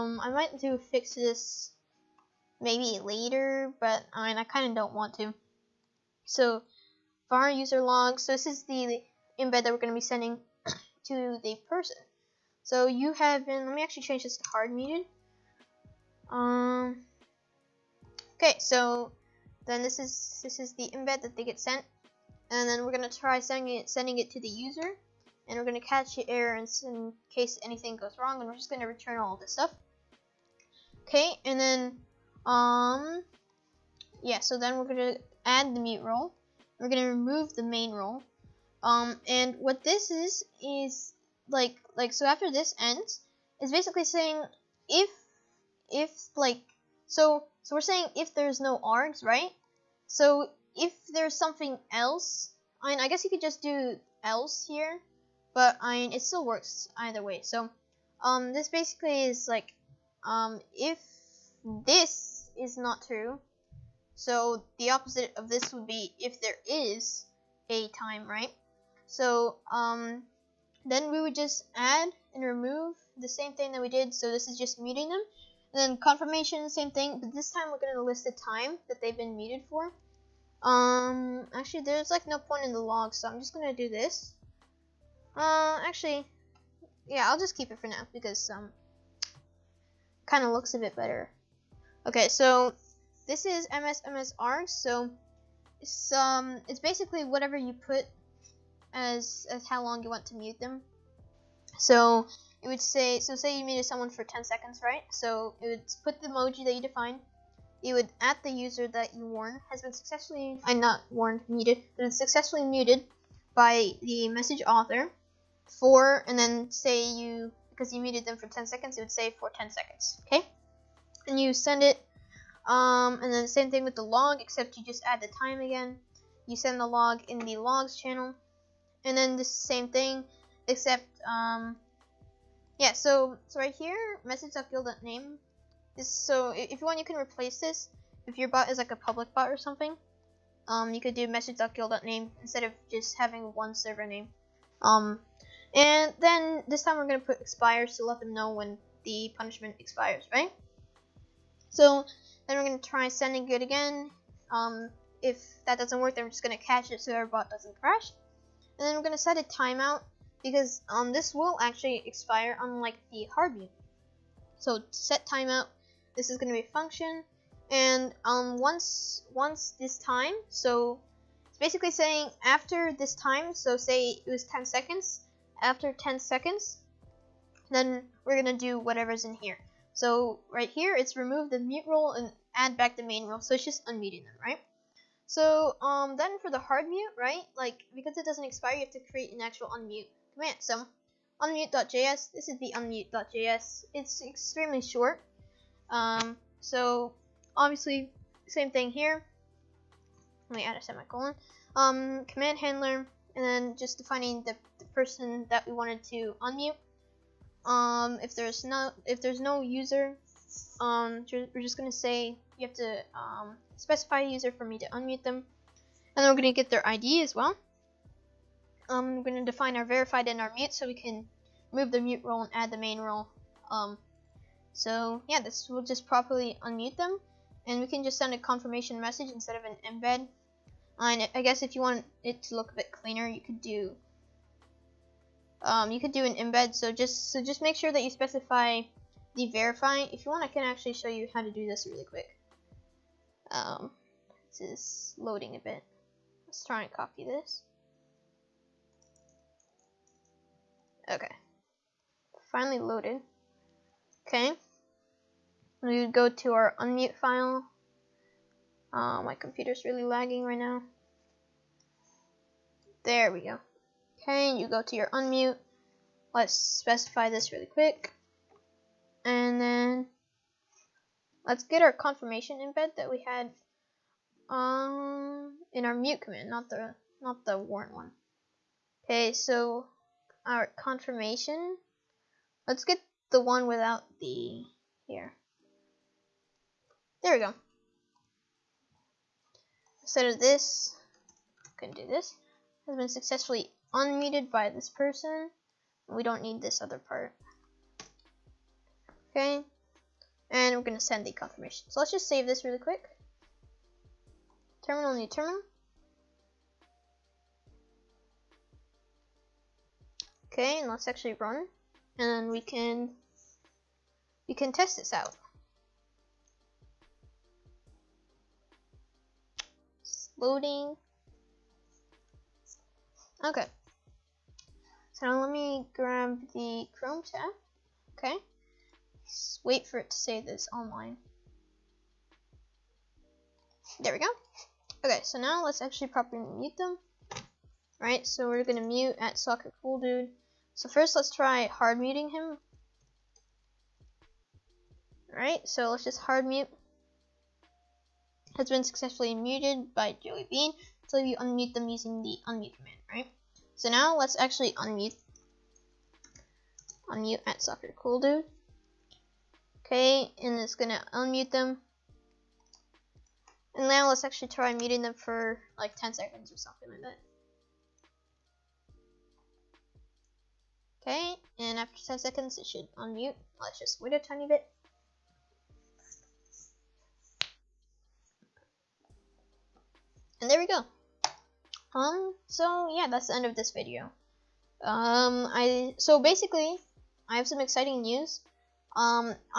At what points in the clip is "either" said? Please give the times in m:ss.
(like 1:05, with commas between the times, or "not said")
0:56.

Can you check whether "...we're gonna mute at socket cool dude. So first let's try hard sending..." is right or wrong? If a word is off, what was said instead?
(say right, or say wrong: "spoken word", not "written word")
wrong: "muting", not "sending".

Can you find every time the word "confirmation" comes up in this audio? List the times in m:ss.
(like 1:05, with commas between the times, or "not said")
1:15, 3:48, 4:31, 4:40, 5:01.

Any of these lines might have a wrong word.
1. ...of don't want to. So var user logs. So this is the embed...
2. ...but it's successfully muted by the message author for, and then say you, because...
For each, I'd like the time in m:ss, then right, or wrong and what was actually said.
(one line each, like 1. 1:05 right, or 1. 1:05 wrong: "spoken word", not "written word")
1. 0:04 right
2. 1:51 right.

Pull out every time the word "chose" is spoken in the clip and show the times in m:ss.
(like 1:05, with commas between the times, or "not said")
not said.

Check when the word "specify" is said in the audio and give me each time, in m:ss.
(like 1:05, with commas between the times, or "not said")
3:33, 3:58, 4:26.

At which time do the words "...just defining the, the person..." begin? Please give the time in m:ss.
3:23.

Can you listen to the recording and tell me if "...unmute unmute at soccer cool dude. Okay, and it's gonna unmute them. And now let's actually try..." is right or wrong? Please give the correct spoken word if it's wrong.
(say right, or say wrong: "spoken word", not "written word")
right.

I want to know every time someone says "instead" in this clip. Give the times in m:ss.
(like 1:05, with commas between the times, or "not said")
2:22, 3:49, 4:50.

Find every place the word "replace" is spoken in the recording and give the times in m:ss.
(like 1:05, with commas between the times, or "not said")
2:17.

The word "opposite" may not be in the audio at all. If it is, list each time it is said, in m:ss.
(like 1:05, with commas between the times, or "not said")
1:04.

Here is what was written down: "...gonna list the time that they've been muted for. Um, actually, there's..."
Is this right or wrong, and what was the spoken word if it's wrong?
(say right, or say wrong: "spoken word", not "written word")
right.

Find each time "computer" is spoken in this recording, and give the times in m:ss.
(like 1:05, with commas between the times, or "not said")
4:19.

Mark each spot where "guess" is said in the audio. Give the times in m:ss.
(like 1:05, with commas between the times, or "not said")
0:53, 3:51.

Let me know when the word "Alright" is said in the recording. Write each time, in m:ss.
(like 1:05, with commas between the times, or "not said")
5:45.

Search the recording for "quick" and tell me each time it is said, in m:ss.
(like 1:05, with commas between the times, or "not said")
4:02, 4:27, 5:02.